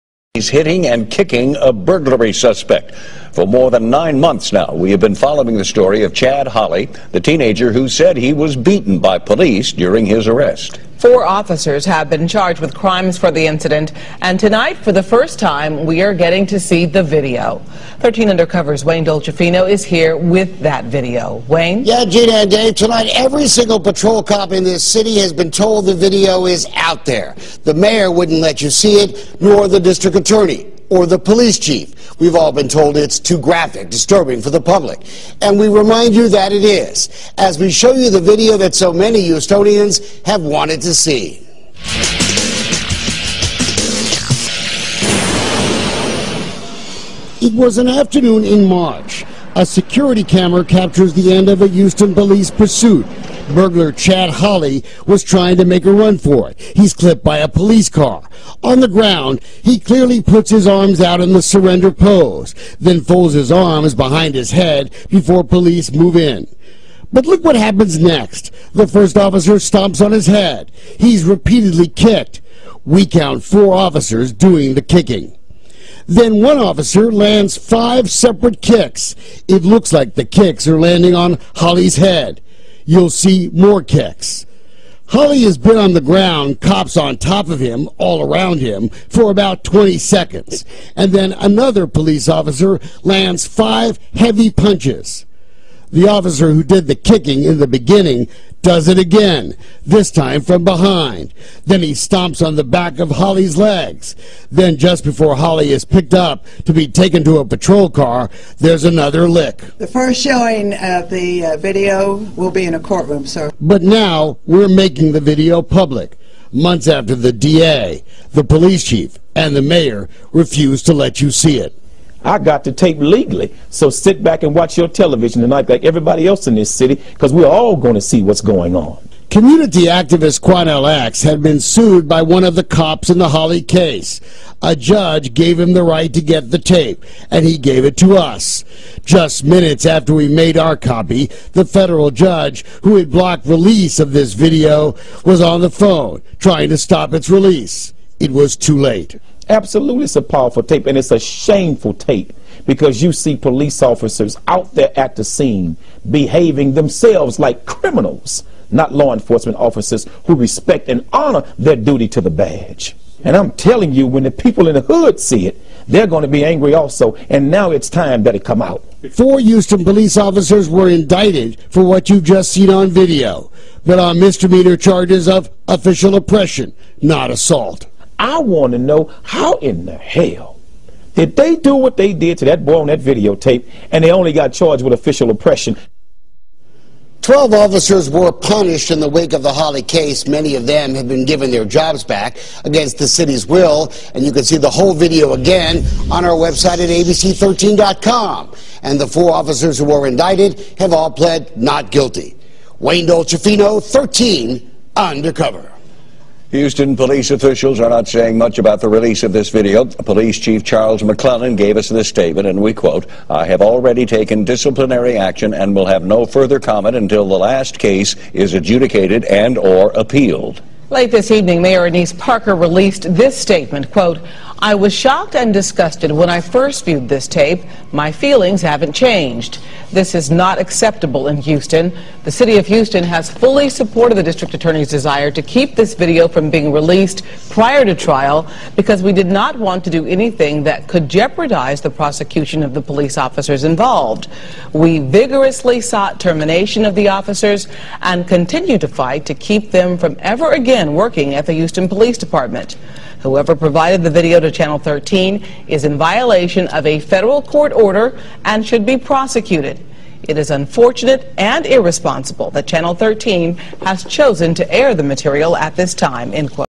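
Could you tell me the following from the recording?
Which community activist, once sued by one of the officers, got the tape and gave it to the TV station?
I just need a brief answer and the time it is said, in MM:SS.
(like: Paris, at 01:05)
Quanell X, at 02:10.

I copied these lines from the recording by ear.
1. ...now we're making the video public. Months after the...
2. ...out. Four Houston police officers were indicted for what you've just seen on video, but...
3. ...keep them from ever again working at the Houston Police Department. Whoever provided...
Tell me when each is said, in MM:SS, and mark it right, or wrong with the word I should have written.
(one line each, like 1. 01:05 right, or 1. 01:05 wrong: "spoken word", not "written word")
1. 01:53 right
2. 02:48 right
3. 04:09 right.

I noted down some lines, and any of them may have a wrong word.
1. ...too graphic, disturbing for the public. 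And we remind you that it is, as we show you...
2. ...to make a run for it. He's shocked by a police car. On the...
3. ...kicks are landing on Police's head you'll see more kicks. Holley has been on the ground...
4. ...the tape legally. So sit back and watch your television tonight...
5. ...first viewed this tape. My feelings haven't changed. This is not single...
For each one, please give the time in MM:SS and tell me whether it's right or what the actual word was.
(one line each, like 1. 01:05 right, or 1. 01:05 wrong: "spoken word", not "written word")
1. 00:33 right
2. 00:55 wrong: "clipped", not "shocked"
3. 01:20 wrong: "Holley", not "Police"
4. 02:02 right
5. 03:46 wrong: "acceptable", not "single".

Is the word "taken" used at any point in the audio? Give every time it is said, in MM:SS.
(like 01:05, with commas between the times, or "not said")
01:46, 03:34.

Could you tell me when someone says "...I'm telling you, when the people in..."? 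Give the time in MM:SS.
02:43.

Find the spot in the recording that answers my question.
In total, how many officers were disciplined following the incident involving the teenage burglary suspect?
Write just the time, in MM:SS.
03:07.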